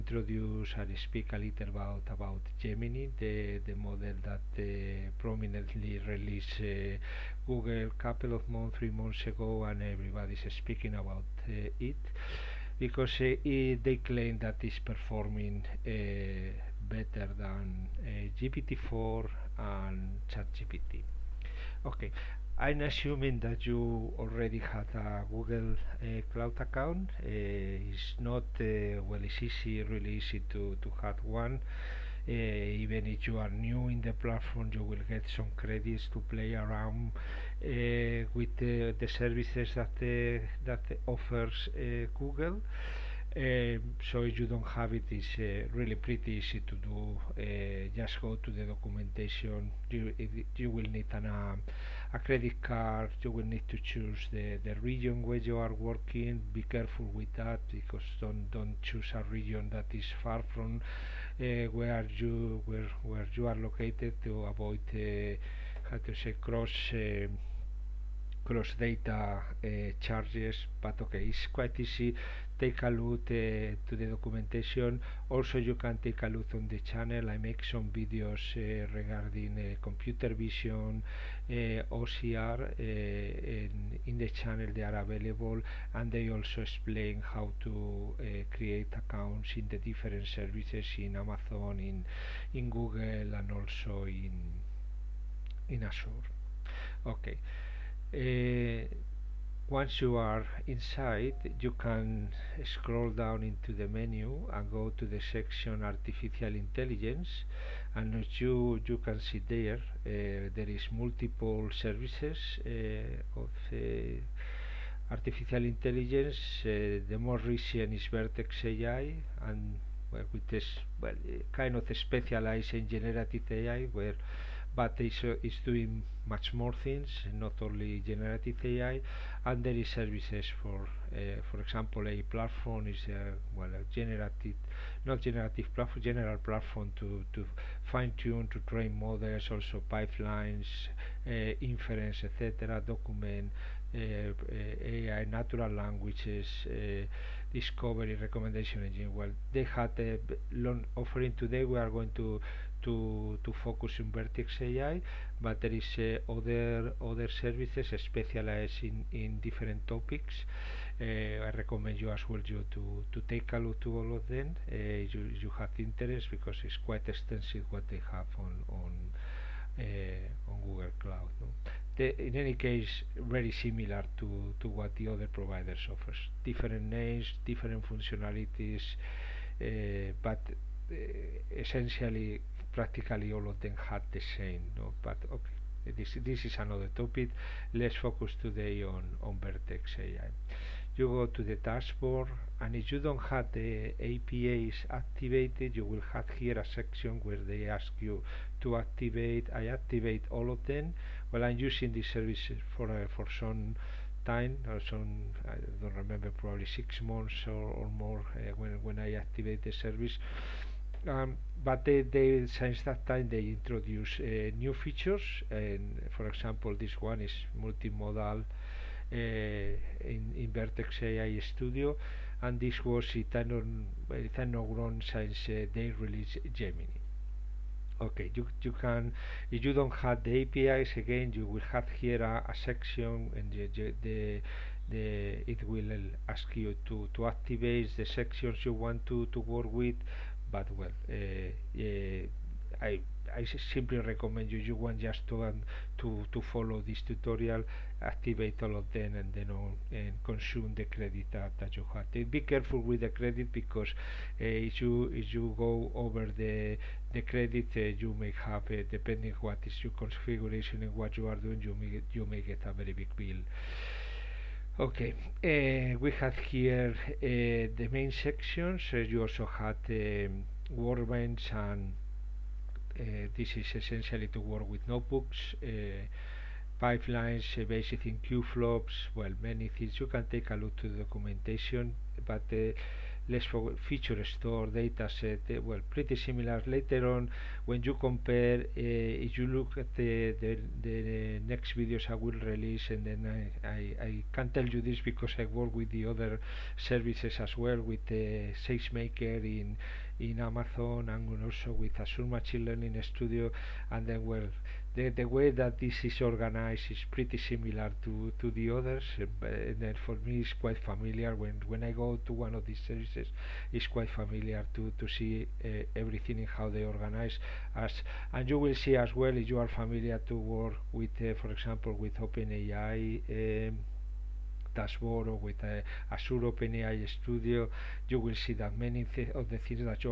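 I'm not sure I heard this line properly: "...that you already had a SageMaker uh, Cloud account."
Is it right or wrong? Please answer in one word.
wrong.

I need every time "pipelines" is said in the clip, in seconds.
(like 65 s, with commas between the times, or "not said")
139 s, 276 s.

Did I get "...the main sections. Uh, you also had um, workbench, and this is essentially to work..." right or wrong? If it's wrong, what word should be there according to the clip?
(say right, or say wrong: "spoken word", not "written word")
right.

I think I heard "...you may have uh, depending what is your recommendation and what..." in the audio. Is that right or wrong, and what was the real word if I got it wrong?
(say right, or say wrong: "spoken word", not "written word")
wrong: "configuration", not "recommendation".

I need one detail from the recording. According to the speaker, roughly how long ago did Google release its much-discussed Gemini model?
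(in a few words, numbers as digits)
3 months.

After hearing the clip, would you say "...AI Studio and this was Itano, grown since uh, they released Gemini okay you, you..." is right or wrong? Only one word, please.
right.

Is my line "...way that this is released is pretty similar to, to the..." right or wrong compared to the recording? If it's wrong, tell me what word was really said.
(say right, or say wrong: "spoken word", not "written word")
wrong: "organized", not "released".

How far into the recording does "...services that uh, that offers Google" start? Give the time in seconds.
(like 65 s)
39 s.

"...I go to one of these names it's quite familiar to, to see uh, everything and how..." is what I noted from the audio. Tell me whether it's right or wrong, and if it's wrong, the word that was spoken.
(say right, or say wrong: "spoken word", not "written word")
wrong: "services", not "names".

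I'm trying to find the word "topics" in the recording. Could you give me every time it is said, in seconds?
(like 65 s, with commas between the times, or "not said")
159 s, 187 s.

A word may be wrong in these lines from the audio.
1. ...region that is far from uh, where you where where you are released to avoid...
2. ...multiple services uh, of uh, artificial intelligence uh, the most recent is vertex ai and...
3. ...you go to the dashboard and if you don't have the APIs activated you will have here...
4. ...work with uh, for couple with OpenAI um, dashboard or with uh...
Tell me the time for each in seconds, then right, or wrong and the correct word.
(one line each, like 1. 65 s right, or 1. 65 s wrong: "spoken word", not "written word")
1. 59 s wrong: "located", not "released"
2. 110 s right
3. 190 s right
4. 320 s wrong: "example", not "couple".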